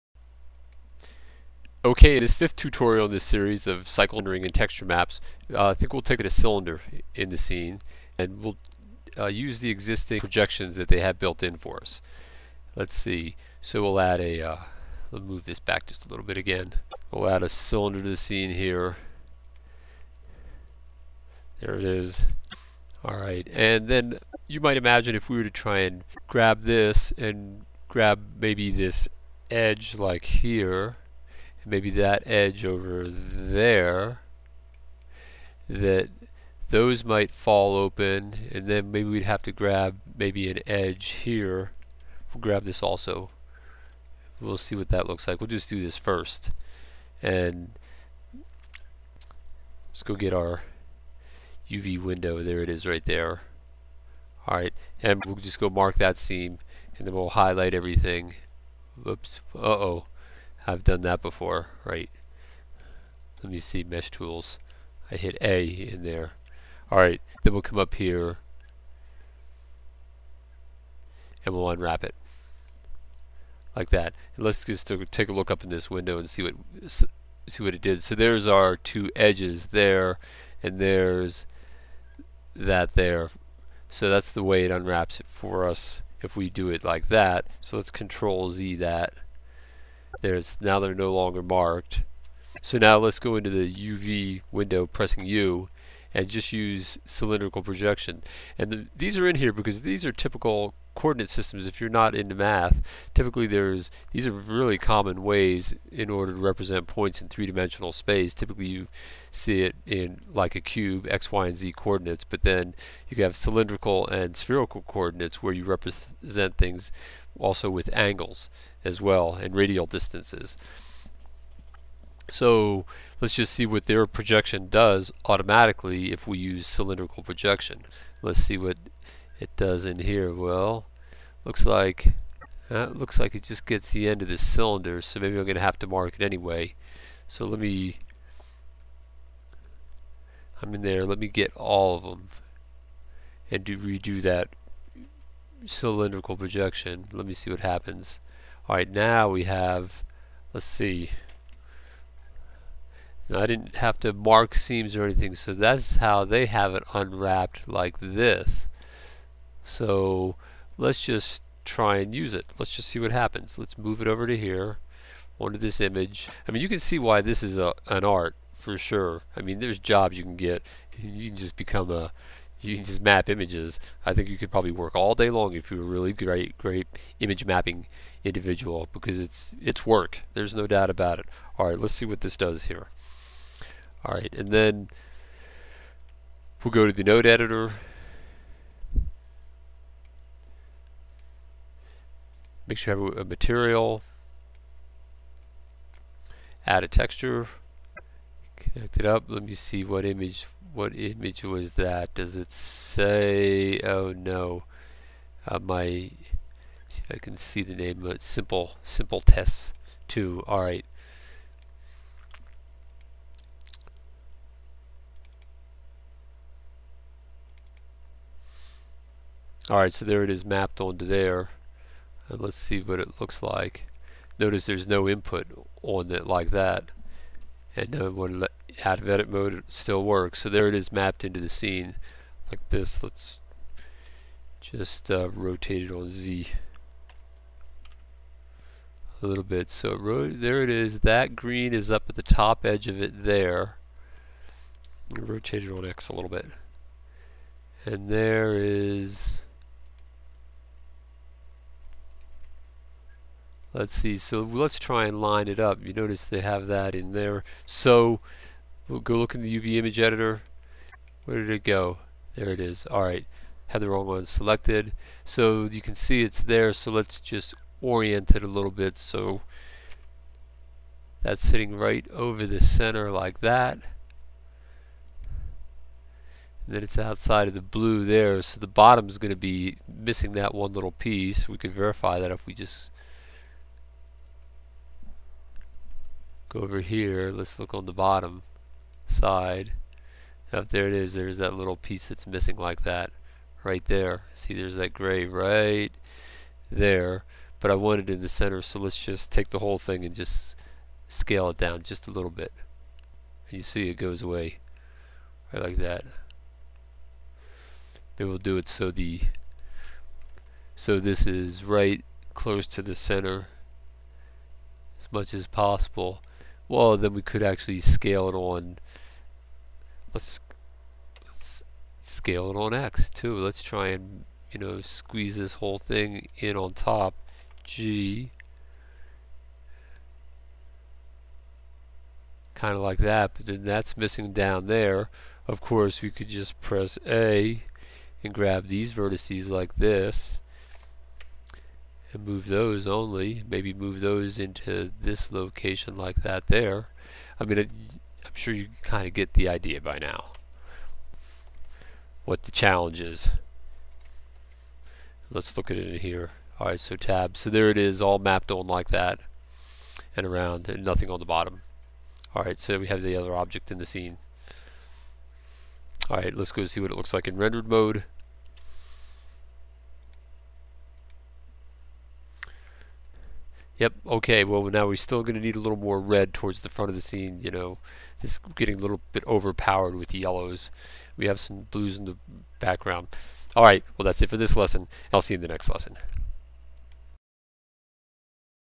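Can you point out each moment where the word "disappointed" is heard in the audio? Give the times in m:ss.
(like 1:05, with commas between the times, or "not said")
not said.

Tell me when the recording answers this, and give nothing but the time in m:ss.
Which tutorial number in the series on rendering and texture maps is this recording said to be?
0:02.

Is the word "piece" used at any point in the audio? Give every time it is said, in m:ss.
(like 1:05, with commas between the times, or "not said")
4:40, 4:51.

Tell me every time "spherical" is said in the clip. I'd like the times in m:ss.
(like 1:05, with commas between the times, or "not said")
1:54.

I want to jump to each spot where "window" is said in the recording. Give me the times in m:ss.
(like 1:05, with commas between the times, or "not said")
0:52, 1:15, 1:34.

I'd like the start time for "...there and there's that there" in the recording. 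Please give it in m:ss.
1:19.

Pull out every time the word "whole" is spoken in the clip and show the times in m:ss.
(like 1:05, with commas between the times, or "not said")
4:59, 5:25.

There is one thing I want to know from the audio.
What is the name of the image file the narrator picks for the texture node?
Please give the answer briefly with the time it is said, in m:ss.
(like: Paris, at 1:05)
simple tests two, at 3:28.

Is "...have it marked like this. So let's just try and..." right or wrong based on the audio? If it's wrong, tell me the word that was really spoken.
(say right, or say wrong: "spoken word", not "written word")
wrong: "unwrapped", not "marked".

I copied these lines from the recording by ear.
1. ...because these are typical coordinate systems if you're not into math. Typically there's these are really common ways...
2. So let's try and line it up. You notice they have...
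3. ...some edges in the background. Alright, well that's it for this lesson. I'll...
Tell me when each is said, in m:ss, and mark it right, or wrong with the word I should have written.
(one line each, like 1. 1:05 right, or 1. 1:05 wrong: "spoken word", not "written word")
1. 1:39 right
2. 4:14 right
3. 6:21 wrong: "blues", not "edges".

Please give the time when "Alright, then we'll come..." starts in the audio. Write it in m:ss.
1:06.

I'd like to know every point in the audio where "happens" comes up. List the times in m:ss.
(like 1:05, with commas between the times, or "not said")
2:27, 2:43.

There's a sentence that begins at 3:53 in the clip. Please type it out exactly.
Let's just uh, rotate it on Z a little bit.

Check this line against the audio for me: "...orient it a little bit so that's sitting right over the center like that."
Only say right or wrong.
right.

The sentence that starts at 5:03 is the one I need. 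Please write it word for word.
And you see it goes away right like that.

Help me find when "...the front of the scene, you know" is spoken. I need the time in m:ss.
6:16.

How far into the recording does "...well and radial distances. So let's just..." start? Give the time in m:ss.
1:59.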